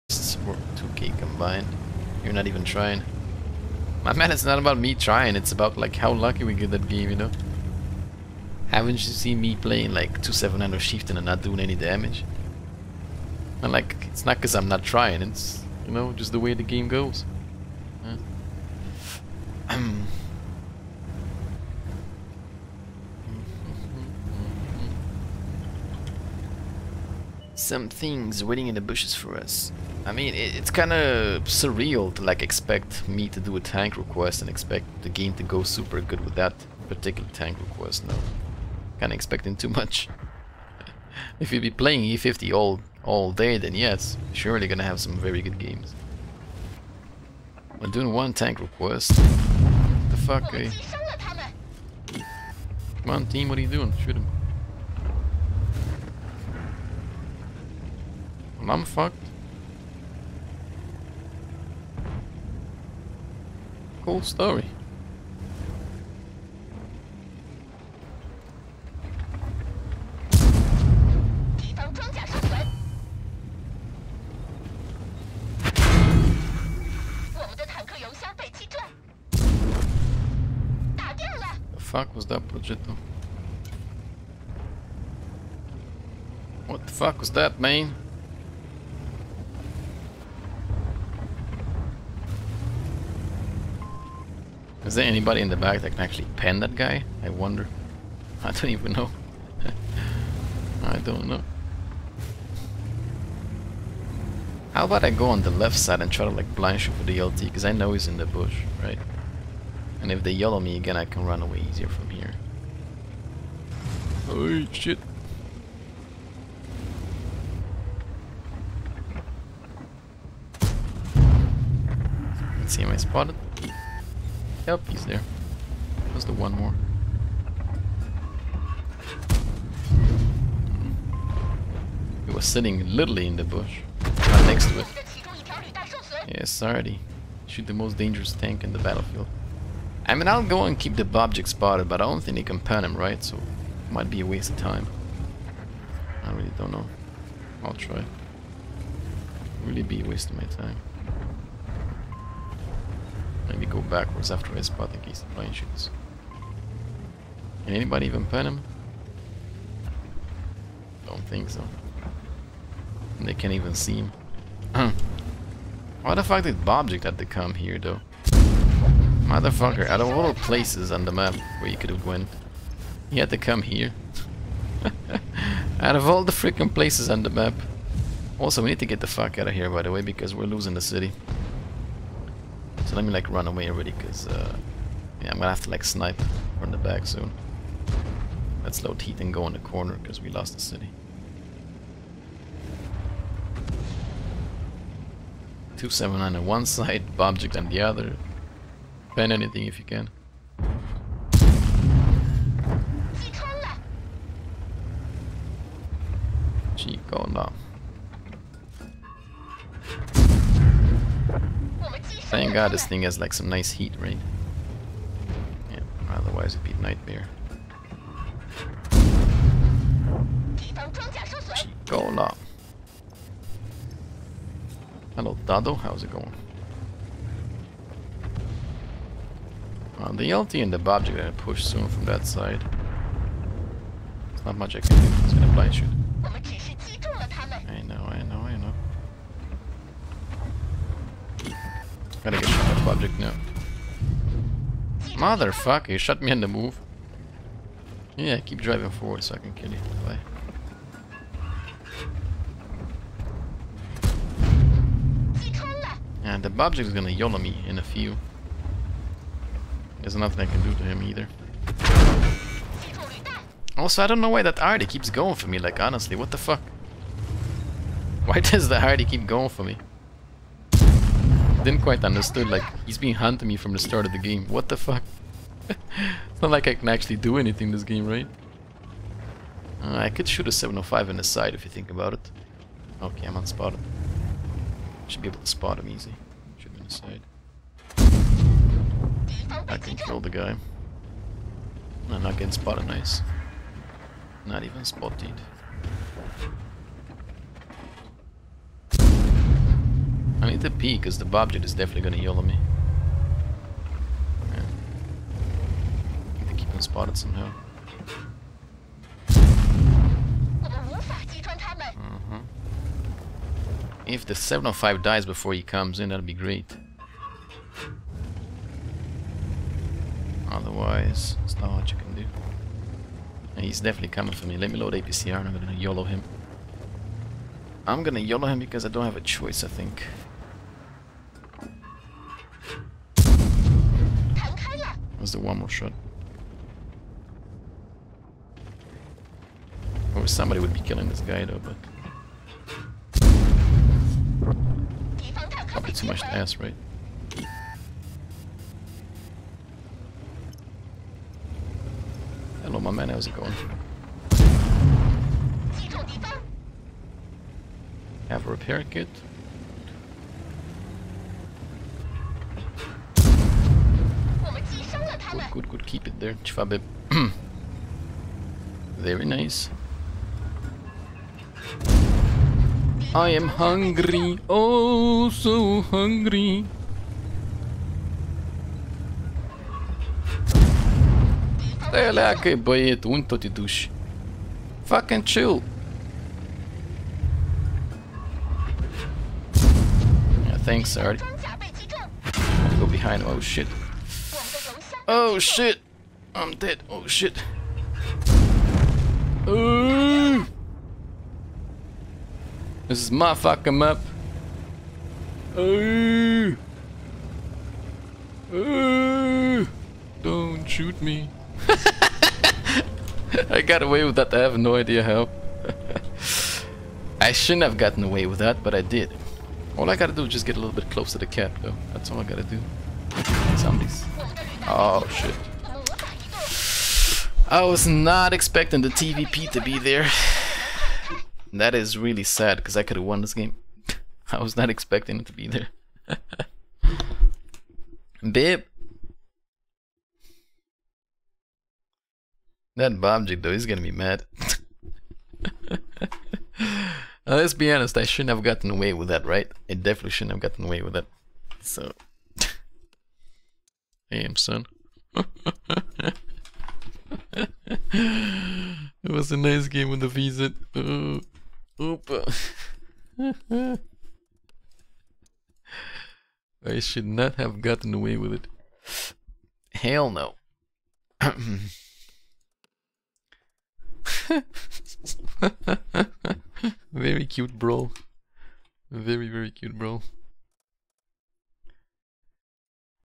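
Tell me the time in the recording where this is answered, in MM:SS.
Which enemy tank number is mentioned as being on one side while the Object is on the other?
03:15.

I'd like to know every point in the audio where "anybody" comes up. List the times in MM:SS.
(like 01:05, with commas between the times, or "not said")
01:35, 02:37.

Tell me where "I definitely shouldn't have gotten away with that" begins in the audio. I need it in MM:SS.
07:29.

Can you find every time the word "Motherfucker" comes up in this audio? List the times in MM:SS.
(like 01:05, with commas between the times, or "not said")
02:49, 04:05.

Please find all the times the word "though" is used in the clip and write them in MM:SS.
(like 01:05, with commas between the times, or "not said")
02:47, 05:41, 07:01, 07:23.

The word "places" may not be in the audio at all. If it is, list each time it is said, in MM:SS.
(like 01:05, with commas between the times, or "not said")
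02:50, 02:56.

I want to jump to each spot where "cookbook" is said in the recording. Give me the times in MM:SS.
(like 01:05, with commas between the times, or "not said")
not said.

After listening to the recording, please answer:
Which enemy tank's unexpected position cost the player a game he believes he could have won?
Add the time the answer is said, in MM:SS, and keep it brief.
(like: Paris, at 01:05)
TVP, at 07:08.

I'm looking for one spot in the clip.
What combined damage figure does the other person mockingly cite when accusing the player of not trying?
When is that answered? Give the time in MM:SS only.
00:00.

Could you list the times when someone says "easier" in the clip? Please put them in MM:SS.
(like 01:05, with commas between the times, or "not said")
01:51.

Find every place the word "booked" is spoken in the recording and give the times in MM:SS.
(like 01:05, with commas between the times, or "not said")
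not said.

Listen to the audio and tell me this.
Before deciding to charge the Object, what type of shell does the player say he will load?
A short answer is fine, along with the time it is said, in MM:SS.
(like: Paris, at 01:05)
APCR, at 05:24.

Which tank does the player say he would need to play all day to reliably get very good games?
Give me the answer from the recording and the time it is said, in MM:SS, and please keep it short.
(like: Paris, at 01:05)
E50, at 00:42.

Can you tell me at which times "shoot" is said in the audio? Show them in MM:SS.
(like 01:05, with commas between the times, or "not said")
00:54, 01:46, 02:17, 02:35, 03:55, 04:40, 06:50.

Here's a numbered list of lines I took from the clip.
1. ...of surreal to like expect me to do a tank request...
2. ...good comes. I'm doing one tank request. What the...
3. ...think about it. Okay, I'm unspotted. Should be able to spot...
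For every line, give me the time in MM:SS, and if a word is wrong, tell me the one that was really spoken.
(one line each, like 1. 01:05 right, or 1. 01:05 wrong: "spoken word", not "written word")
1. 00:30 right
2. 00:45 wrong: "games", not "comes"
3. 04:41 right.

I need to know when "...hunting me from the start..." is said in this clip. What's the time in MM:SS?
04:33.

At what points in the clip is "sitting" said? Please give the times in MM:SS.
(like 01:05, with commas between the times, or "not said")
02:12.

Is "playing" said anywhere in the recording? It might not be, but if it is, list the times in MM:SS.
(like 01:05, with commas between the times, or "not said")
00:09, 00:41.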